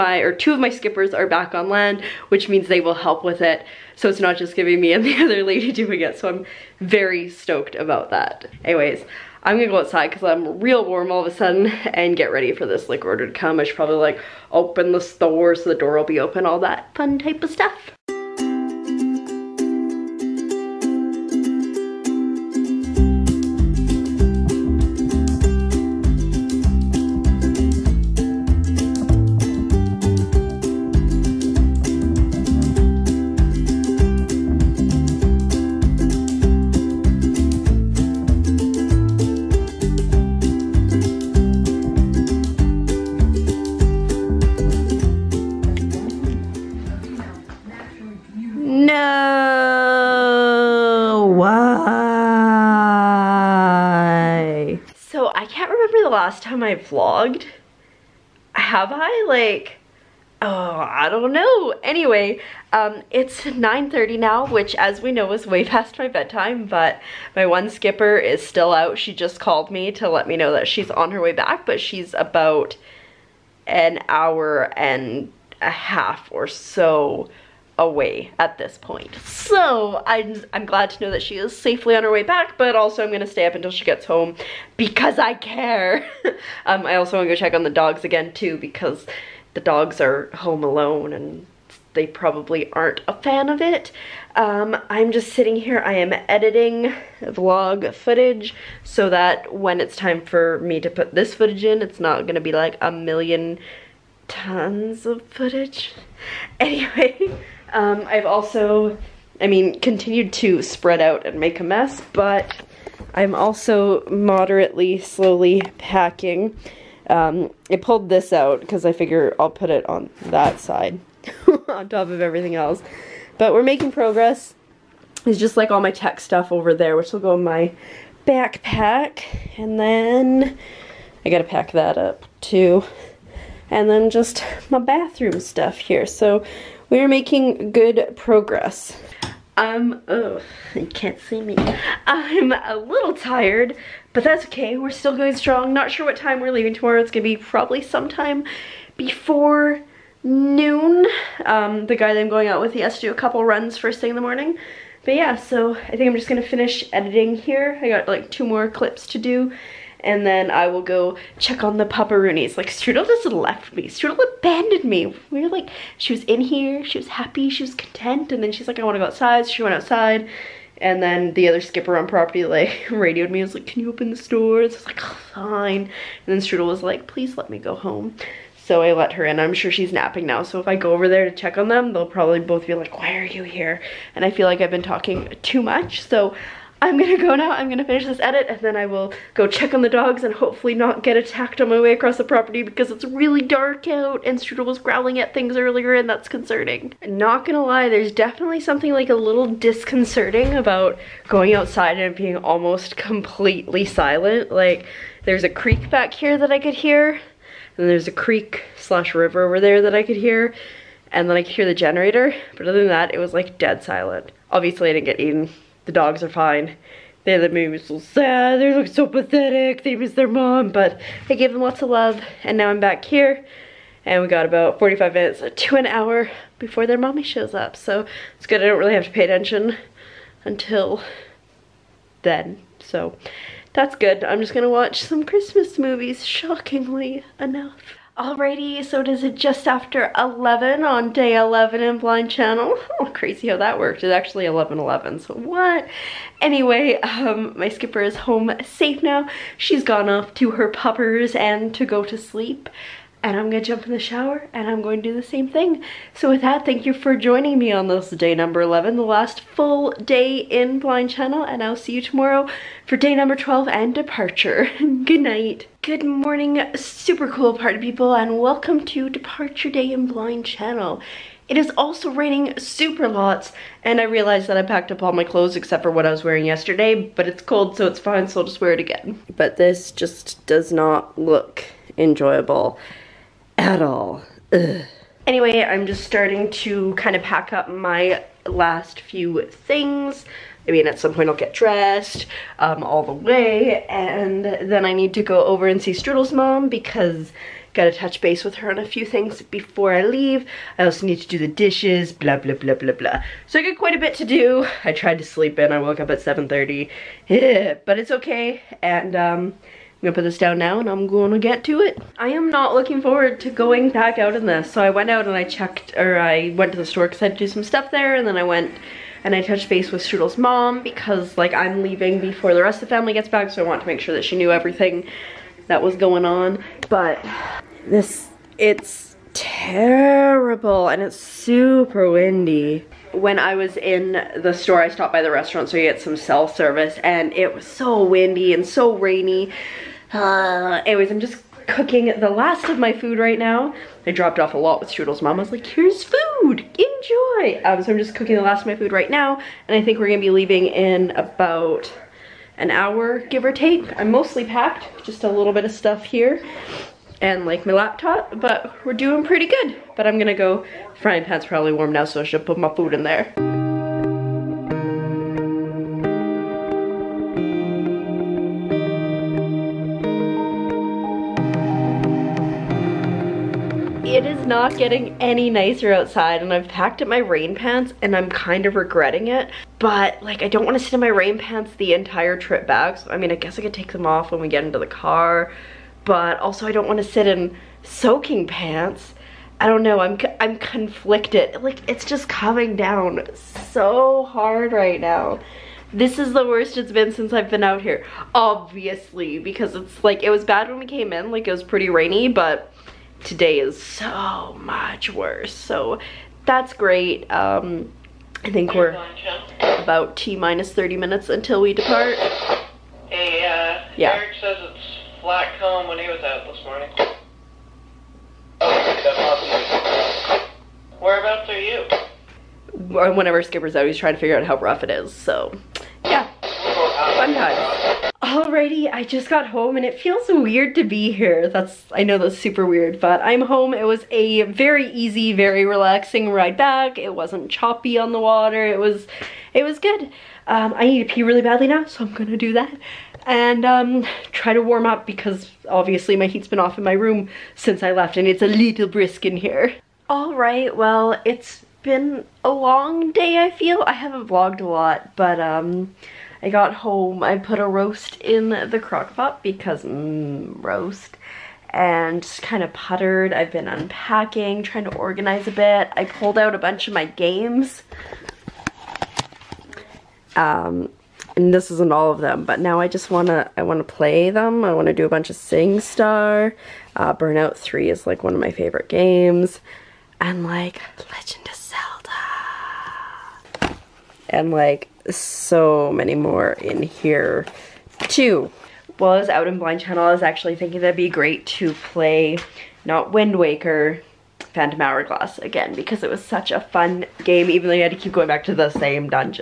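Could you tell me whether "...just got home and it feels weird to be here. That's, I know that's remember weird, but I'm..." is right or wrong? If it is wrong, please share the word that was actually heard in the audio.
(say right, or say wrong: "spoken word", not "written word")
wrong: "super", not "remember".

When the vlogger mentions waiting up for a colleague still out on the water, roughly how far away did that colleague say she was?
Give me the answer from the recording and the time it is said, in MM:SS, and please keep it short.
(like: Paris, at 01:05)
an hour and a half, at 01:13.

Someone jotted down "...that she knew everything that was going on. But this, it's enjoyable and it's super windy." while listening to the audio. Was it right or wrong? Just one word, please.
wrong.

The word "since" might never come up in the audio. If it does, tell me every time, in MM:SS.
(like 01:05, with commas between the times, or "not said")
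06:37, 07:27.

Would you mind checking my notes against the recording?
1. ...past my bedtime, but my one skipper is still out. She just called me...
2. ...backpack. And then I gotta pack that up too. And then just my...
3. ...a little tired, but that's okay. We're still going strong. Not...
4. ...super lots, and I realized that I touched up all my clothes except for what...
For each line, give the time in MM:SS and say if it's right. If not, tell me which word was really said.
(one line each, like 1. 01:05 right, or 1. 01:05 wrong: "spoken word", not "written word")
1. 01:05 right
2. 02:08 right
3. 02:22 right
4. 04:32 wrong: "packed", not "touched".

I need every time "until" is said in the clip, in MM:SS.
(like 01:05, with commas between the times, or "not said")
01:23, 03:50, 06:51.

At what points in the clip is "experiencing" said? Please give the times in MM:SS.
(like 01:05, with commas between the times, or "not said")
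not said.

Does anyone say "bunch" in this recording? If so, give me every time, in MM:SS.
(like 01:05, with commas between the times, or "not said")
07:46, 07:55.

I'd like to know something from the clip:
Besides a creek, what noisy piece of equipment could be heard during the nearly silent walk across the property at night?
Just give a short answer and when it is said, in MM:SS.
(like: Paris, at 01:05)
the generator, at 03:31.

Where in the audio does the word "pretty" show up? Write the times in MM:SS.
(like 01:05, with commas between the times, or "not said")
05:59, 06:41.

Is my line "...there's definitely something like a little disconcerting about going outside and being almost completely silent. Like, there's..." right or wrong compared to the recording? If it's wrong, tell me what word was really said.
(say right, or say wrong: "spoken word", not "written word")
right.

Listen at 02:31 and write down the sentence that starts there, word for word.
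Um, the guy that I'm going out with, he has to do a couple runs first thing in the morning.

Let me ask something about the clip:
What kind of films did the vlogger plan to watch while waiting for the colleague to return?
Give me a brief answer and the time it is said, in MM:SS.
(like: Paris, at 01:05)
Christmas movies, at 03:55.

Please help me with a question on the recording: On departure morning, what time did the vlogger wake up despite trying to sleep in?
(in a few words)
7:30.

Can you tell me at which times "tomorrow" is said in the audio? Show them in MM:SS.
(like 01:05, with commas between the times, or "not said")
02:26, 04:21.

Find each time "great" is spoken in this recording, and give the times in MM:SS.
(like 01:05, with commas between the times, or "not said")
06:46, 08:11.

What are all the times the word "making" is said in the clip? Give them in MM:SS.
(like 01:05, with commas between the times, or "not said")
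02:03, 02:17.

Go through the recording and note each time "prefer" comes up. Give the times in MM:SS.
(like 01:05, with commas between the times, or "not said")
not said.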